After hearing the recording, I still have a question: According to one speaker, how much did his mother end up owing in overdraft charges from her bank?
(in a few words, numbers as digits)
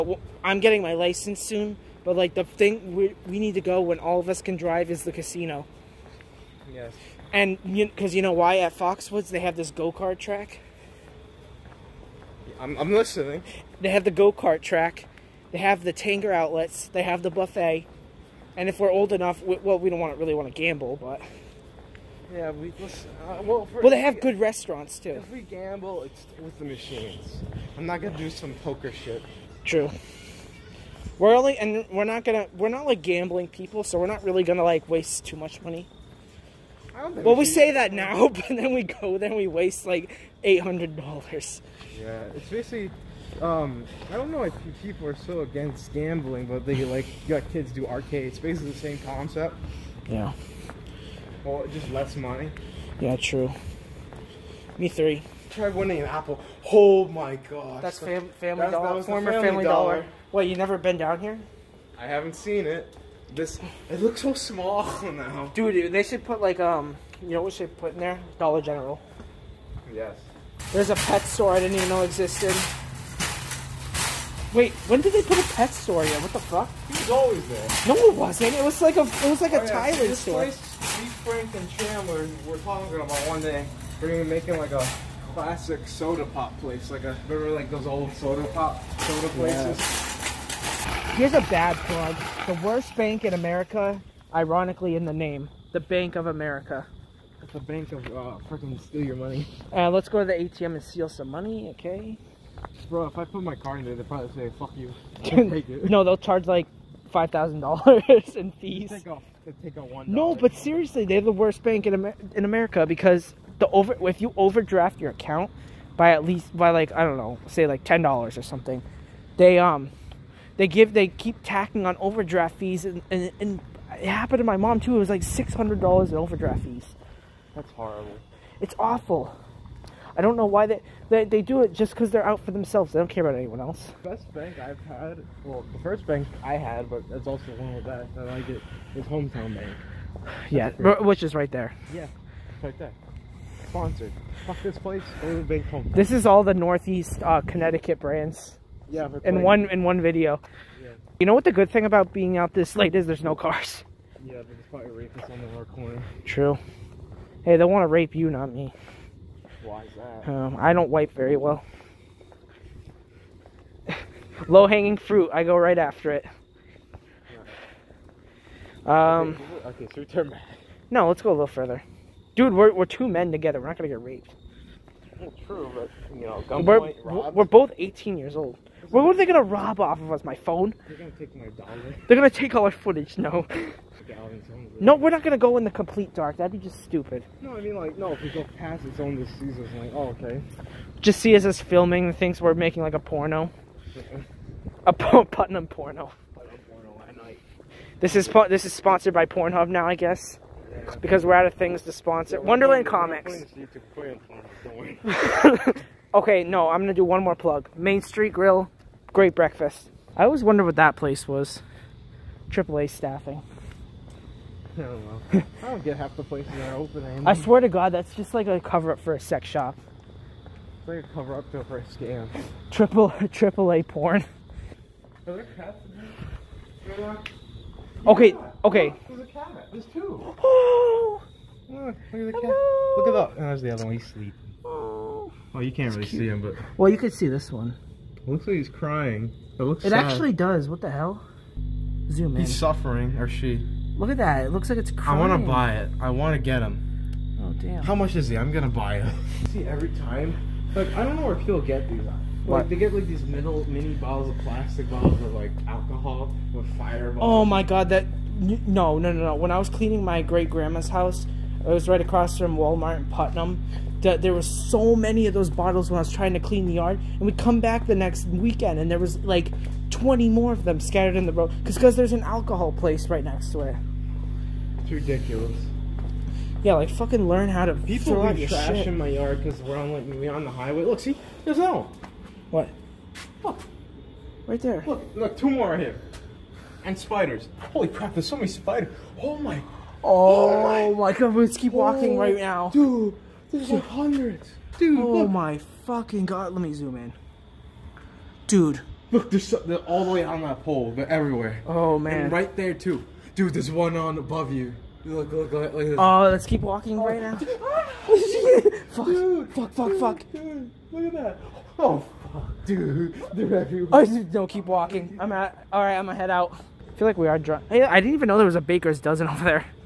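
$600.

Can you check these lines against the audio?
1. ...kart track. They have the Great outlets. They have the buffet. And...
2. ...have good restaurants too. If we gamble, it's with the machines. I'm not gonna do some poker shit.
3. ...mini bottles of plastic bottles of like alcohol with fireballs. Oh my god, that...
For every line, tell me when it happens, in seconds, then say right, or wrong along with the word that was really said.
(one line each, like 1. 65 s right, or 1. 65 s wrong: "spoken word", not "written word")
1. 14 s wrong: "Tanger", not "Great"
2. 24 s right
3. 253 s right.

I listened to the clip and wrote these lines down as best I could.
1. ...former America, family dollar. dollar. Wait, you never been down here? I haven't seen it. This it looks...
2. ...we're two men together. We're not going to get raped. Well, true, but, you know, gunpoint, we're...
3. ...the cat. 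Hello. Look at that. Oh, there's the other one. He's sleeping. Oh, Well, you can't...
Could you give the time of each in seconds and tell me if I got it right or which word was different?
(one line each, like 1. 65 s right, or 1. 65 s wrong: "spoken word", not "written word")
1. 59 s wrong: "Family", not "America"
2. 172 s right
3. 232 s right.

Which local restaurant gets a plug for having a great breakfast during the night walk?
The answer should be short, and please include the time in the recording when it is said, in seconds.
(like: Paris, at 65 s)
Main Street Grill, at 207 s.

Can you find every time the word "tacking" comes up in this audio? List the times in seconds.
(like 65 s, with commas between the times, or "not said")
121 s.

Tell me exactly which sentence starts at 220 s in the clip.
It's like a cover up for a scam.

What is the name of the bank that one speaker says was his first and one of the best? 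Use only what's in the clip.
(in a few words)
Hometown Bank.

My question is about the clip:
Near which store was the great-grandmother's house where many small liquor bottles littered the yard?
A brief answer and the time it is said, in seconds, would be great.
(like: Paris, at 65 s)
Walmart, at 262 s.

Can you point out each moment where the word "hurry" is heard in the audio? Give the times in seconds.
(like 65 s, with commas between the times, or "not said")
not said.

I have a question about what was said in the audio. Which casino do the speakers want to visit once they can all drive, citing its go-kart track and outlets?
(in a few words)
Foxwoods.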